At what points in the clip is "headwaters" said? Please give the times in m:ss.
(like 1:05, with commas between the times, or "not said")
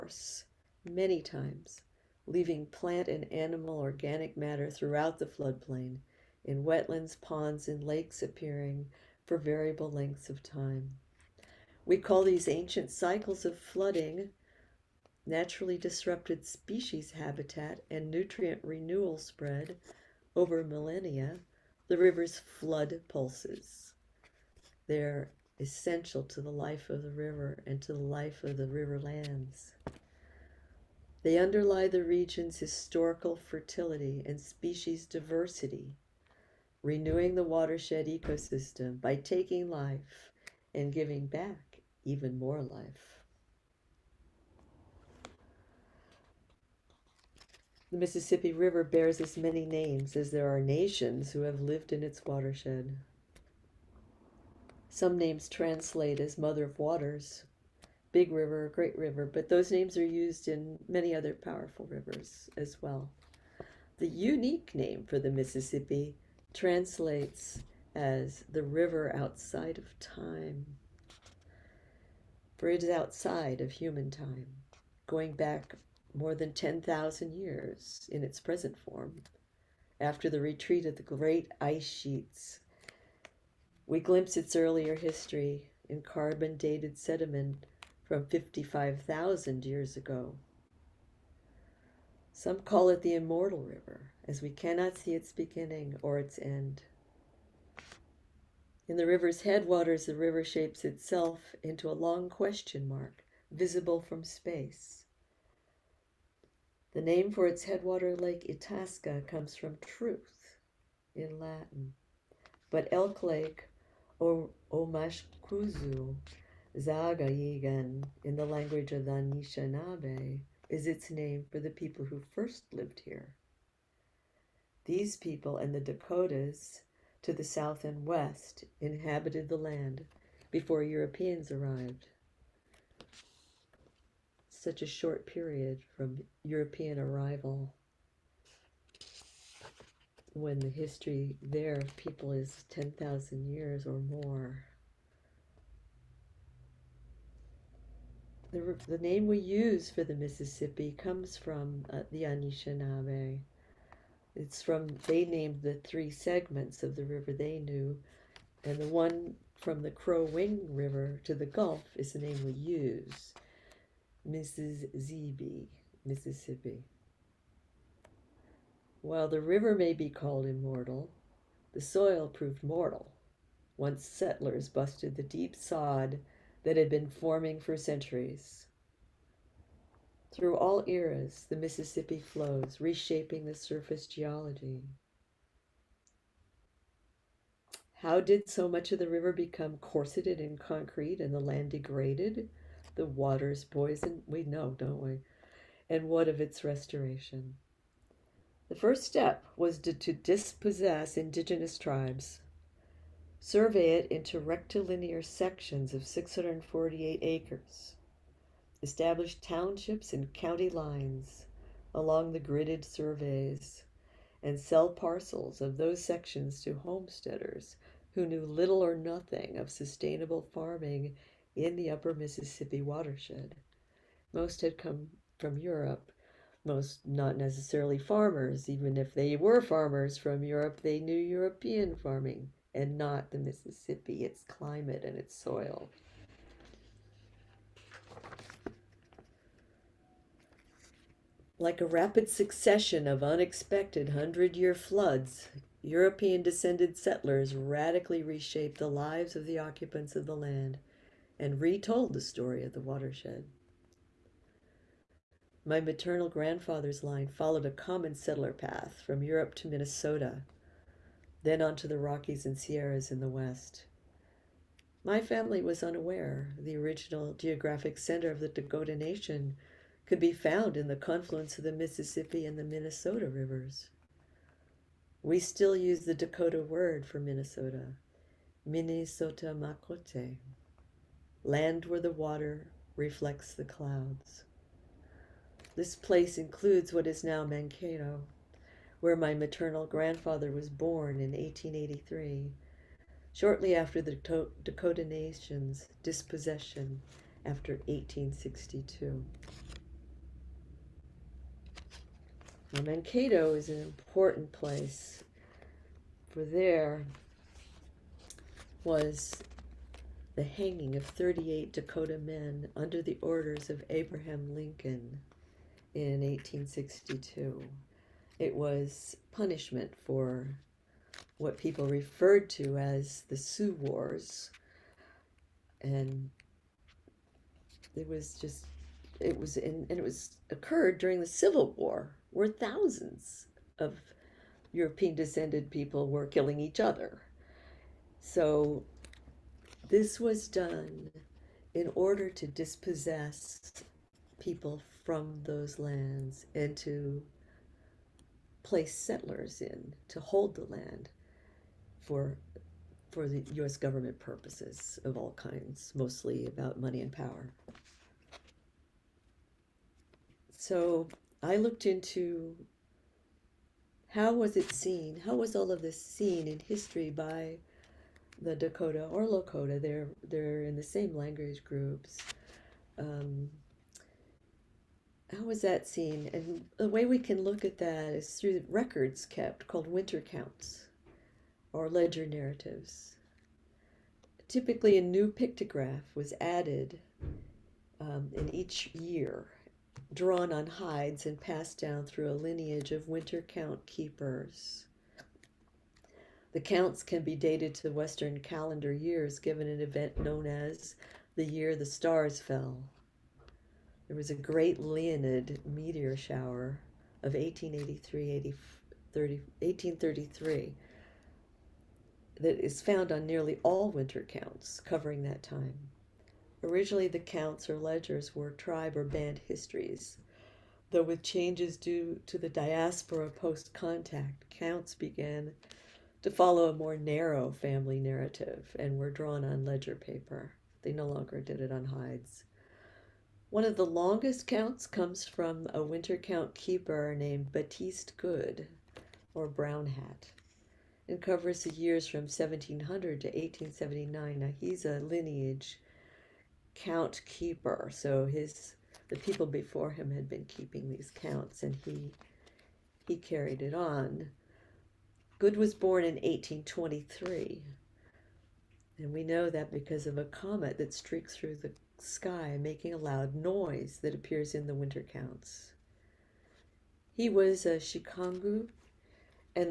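1:39, 1:47.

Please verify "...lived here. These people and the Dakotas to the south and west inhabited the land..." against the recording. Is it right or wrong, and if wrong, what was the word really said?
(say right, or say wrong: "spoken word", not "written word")
right.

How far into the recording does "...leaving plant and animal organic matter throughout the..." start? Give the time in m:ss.
0:02.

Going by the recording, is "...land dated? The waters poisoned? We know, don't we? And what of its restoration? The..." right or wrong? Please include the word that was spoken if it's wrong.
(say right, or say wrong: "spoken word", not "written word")
wrong: "degraded", not "dated".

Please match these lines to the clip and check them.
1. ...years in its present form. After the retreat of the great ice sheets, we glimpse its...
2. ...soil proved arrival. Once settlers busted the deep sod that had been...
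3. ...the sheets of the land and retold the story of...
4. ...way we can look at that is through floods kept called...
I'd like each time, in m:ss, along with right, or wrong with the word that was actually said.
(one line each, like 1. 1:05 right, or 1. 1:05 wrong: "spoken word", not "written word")
1. 1:17 right
2. 2:51 wrong: "mortal", not "arrival"
3. 4:09 wrong: "occupants", not "sheets"
4. 6:16 wrong: "records", not "floods".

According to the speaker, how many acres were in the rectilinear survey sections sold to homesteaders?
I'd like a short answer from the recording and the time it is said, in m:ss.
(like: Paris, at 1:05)
648 acres, at 3:26.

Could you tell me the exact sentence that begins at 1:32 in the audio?
Some call it the immortal river, as we cannot see its beginning or its end.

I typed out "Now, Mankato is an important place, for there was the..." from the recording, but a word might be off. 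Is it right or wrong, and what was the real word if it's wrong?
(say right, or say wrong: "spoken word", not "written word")
right.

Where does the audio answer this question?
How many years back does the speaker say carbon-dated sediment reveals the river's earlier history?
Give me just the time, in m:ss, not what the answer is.
1:28.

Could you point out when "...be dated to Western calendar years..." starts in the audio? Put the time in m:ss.
6:37.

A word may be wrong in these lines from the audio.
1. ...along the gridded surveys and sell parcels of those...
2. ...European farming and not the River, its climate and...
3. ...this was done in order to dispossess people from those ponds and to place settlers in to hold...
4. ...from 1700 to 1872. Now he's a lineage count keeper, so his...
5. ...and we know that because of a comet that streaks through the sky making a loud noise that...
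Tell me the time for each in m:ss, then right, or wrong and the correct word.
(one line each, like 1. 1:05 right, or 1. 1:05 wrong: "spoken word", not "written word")
1. 3:31 right
2. 3:51 wrong: "Mississippi", not "River"
3. 5:39 wrong: "lands", not "ponds"
4. 7:22 wrong: "1879", not "1872"
5. 7:38 right.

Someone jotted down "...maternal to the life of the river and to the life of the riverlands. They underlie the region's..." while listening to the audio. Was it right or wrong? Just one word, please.
wrong.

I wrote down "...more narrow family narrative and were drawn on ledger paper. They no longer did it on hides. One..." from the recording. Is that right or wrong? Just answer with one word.
right.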